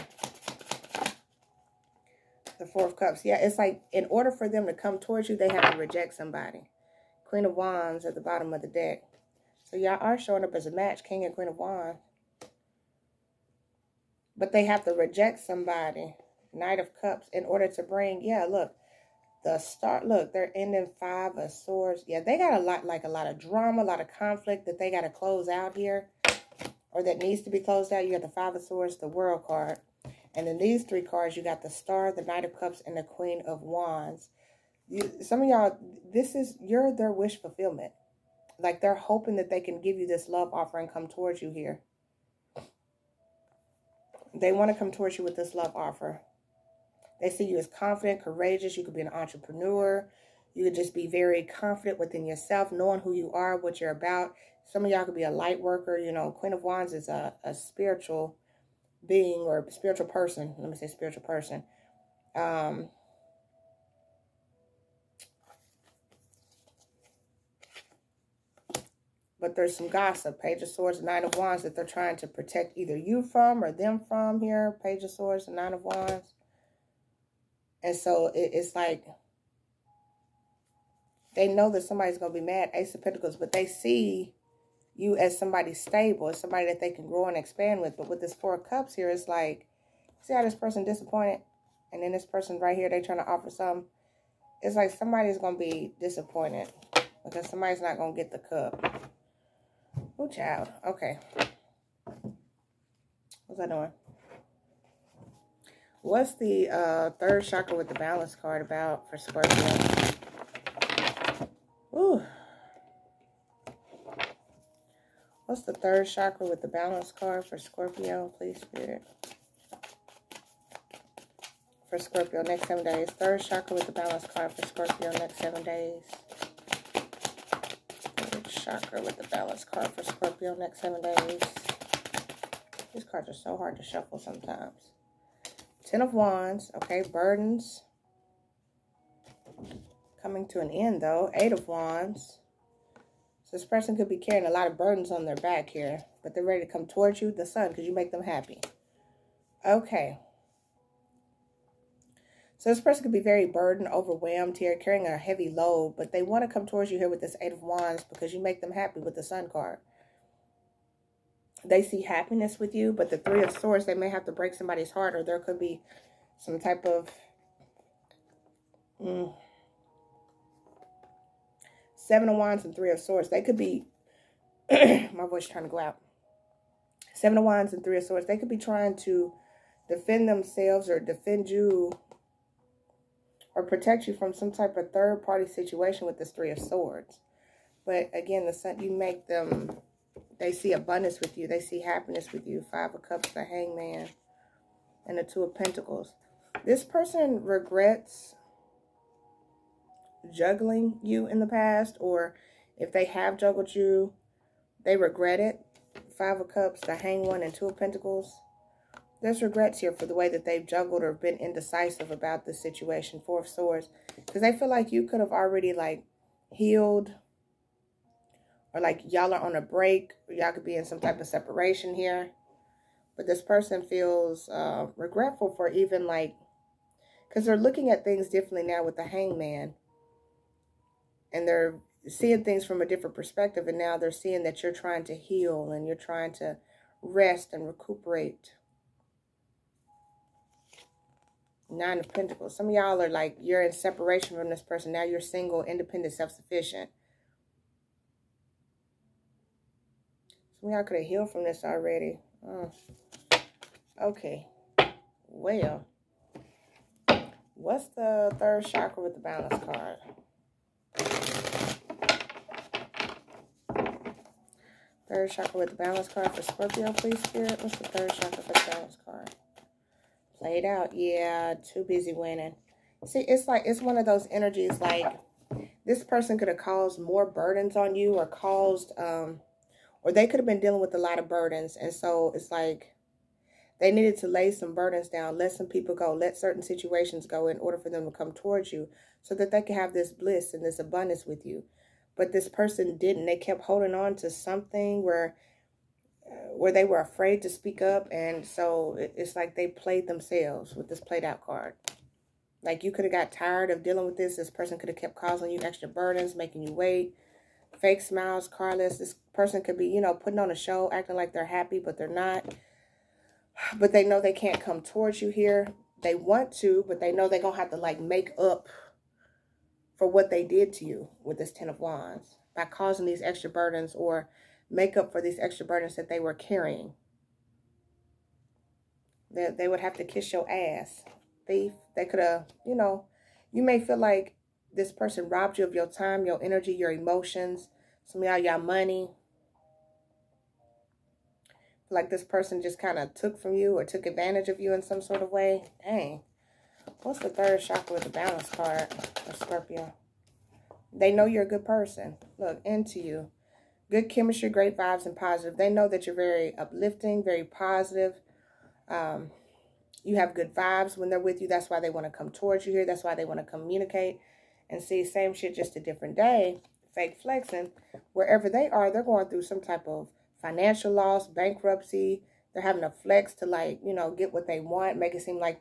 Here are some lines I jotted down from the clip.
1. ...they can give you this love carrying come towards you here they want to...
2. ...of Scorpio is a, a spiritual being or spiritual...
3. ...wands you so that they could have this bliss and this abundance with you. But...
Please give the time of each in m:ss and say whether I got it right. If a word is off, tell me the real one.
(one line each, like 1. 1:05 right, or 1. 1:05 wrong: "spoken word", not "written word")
1. 0:39 wrong: "offering", not "carrying"
2. 0:56 wrong: "Wands", not "Scorpio"
3. 4:48 wrong: "towards", not "wands".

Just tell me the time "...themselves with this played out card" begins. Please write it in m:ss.
5:00.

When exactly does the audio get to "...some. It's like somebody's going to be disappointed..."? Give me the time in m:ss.
1:33.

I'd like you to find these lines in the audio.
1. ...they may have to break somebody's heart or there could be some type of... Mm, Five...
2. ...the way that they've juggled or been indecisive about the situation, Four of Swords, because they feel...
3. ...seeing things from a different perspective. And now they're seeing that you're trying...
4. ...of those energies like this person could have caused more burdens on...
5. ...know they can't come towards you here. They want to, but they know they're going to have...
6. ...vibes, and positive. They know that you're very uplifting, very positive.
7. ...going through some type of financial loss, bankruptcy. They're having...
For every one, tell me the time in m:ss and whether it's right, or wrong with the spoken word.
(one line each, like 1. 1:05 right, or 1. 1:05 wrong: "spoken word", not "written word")
1. 2:43 wrong: "Seven", not "Five"
2. 3:30 right
3. 3:52 right
4. 4:33 right
5. 5:14 right
6. 5:54 right
7. 6:09 right.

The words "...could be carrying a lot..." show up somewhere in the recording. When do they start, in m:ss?
2:23.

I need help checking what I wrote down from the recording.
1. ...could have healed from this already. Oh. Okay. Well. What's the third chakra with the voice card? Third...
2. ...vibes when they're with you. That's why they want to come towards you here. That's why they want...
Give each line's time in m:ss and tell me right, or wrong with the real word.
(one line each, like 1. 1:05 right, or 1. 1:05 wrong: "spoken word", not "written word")
1. 4:10 wrong: "balance", not "voice"
2. 6:00 right.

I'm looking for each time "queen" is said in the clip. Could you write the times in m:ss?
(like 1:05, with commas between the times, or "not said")
0:07, 0:11, 0:33, 0:56.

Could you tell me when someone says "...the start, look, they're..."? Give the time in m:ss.
0:19.